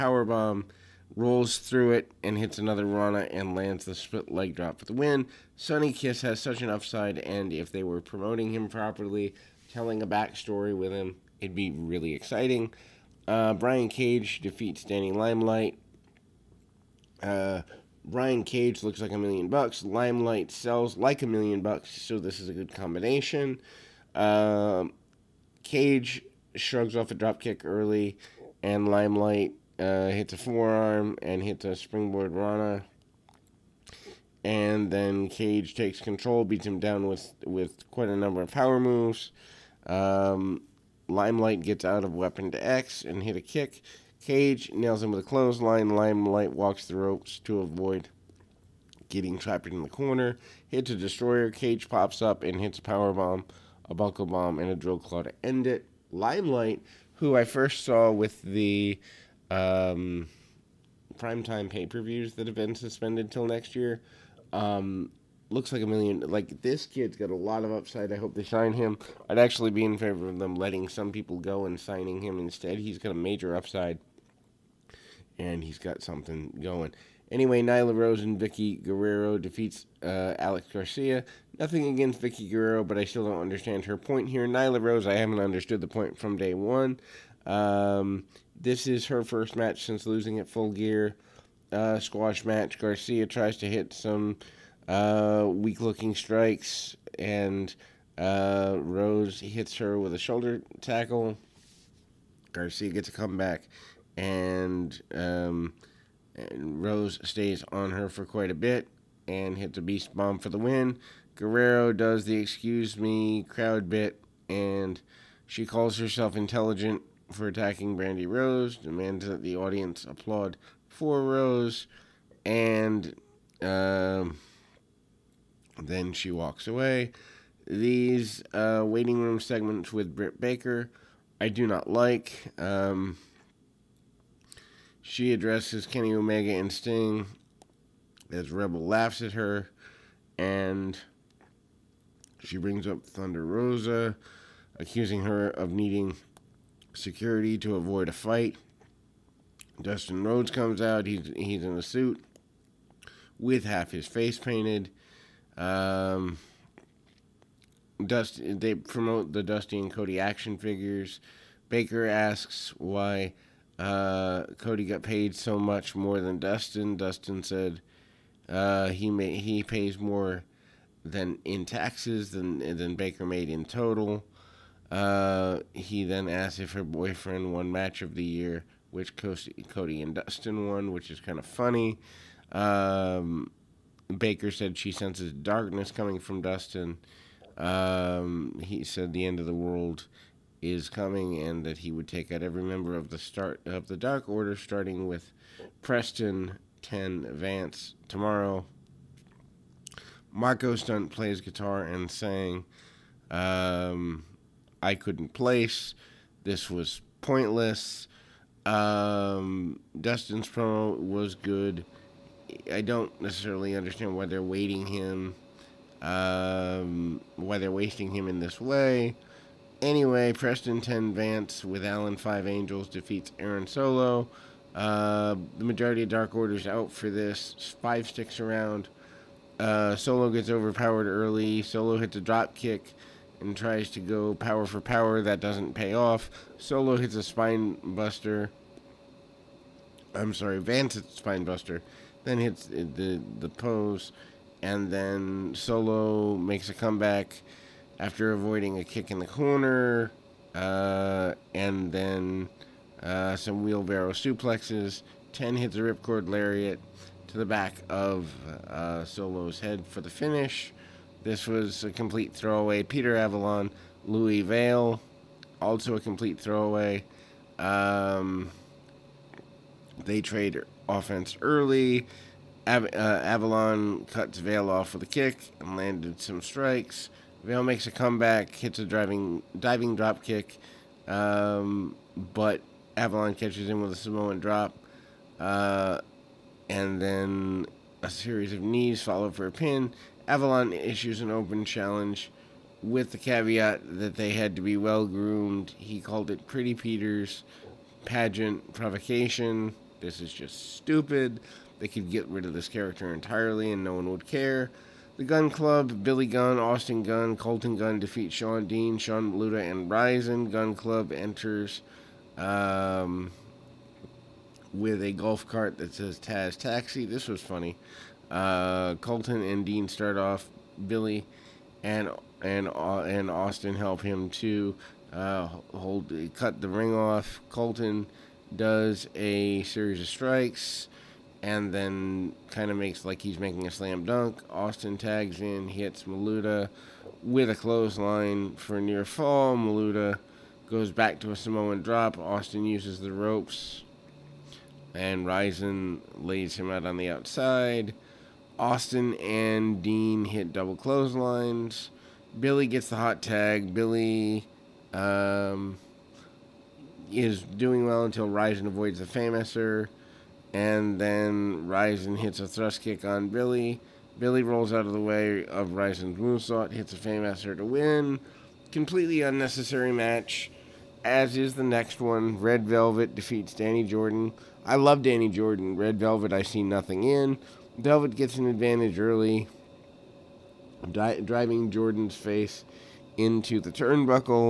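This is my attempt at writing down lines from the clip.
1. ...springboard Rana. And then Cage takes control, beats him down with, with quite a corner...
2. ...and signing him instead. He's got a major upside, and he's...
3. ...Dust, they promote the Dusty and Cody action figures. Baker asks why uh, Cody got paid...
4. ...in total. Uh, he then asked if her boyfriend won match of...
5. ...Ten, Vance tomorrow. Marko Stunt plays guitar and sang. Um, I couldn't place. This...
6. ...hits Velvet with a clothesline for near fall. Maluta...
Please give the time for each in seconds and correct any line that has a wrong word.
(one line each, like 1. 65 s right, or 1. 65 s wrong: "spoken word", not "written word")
1. 31 s wrong: "number", not "corner"
2. 71 s right
3. 158 s right
4. 173 s right
5. 196 s right
6. 335 s wrong: "Maluta", not "Velvet".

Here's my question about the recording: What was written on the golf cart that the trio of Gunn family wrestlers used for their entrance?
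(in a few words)
Taz Taxi.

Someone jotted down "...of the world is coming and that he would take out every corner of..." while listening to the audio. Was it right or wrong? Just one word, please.
wrong.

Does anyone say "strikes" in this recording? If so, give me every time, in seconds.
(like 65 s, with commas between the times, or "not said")
96 s, 276 s, 330 s.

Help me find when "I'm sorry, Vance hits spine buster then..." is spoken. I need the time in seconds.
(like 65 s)
240 s.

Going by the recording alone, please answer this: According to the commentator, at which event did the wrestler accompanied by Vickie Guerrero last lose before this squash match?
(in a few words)
Full Gear.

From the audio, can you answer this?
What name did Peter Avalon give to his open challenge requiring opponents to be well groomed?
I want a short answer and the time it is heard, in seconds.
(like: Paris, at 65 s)
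Pretty Peter's pageant provocation, at 296 s.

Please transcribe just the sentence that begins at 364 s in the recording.
Billy rolls out of the way of Ryzen's moonsault, hits a Fameasser to win.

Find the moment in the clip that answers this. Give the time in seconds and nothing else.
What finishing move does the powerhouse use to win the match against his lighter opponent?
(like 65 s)
54 s.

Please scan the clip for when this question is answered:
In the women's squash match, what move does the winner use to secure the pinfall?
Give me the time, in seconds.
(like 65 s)
109 s.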